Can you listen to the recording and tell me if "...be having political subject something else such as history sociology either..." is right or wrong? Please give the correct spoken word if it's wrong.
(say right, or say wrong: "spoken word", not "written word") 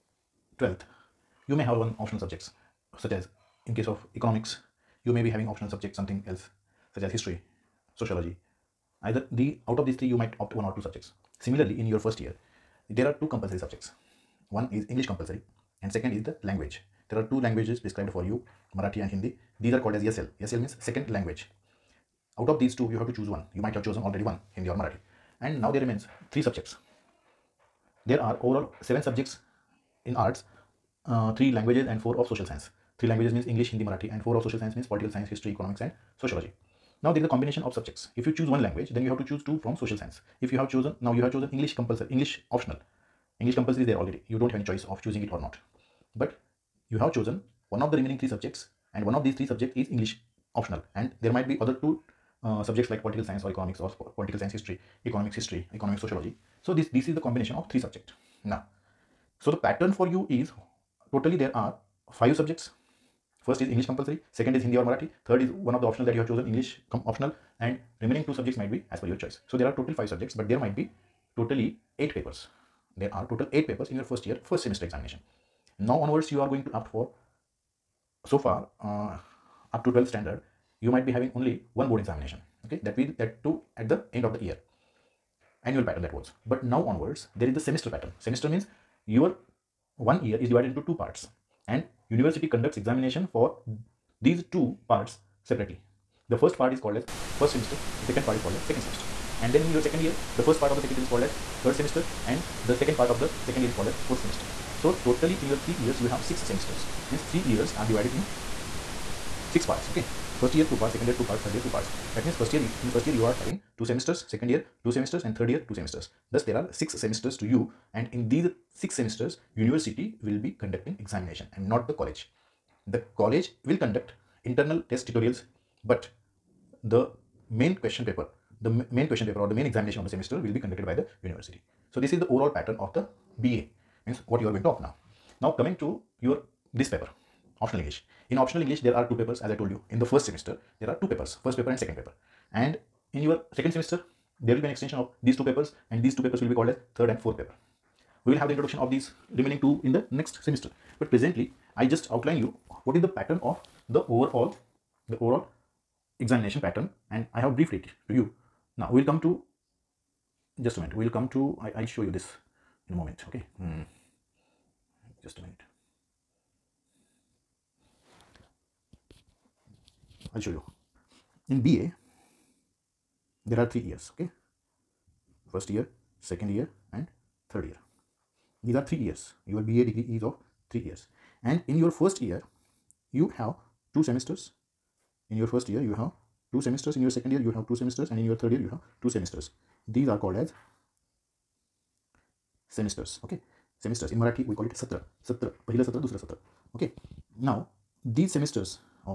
wrong: "optional", not "political".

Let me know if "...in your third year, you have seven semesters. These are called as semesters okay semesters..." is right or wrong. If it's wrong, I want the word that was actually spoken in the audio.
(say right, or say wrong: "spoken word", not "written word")
wrong: "two", not "seven".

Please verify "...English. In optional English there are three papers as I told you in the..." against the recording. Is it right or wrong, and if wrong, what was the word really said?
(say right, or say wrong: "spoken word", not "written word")
wrong: "two", not "three".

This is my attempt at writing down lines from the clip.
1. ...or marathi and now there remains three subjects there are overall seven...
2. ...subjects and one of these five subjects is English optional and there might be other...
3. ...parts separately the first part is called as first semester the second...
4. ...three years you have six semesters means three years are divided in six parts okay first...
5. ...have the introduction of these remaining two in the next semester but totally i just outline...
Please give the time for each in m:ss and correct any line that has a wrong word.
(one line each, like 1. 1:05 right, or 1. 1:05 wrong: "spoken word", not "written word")
1. 0:24 right
2. 0:48 wrong: "three", not "five"
3. 1:34 right
4. 1:45 right
5. 2:28 wrong: "presently", not "totally".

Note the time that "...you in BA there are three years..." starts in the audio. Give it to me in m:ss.
2:50.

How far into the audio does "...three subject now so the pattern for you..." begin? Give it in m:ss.
0:57.